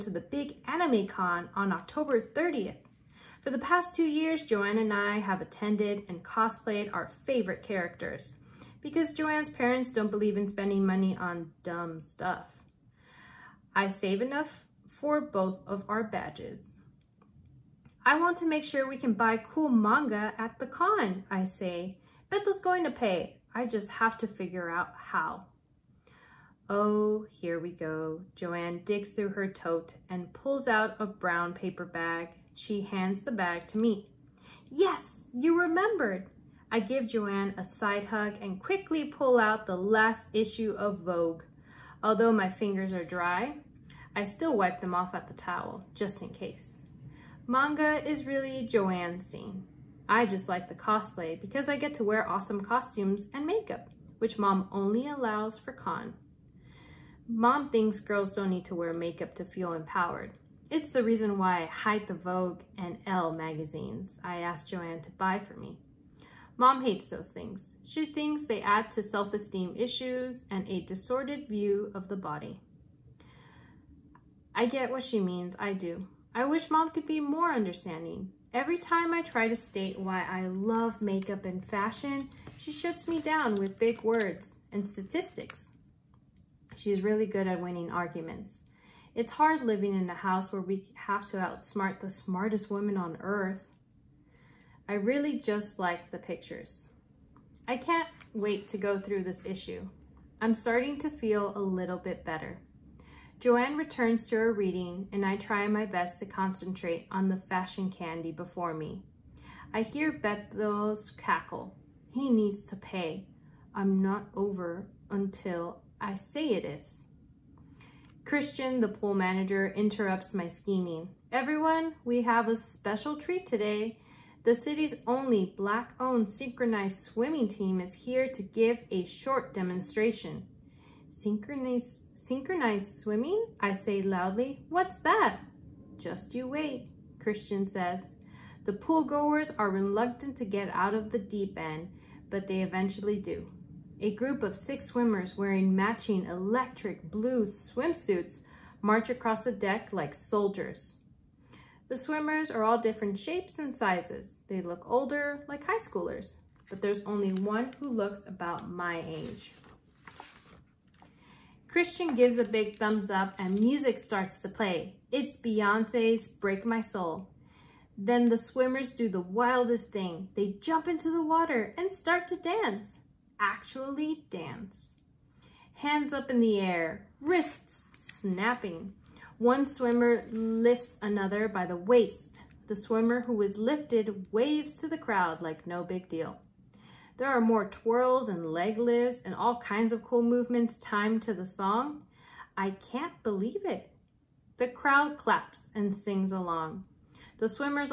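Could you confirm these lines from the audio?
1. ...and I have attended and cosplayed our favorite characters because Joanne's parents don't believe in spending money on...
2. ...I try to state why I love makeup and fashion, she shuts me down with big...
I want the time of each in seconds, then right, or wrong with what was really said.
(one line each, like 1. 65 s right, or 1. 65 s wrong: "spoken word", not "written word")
1. 4 s right
2. 79 s right.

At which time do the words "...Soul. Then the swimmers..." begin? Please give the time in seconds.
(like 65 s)
166 s.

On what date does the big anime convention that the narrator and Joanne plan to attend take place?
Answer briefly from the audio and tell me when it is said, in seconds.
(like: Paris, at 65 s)
October 30th, at 1 s.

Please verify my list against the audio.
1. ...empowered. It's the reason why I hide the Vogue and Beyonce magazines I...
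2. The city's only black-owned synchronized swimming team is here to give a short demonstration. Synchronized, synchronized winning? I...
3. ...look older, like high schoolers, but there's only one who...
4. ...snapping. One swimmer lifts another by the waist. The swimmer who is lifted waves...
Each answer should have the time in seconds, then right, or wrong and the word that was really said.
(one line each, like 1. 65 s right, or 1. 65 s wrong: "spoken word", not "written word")
1. 59 s wrong: "Elle", not "Beyonce"
2. 124 s wrong: "swimming", not "winning"
3. 154 s right
4. 177 s right.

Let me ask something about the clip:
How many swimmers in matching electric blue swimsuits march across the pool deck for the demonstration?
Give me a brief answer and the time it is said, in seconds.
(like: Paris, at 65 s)
6, at 144 s.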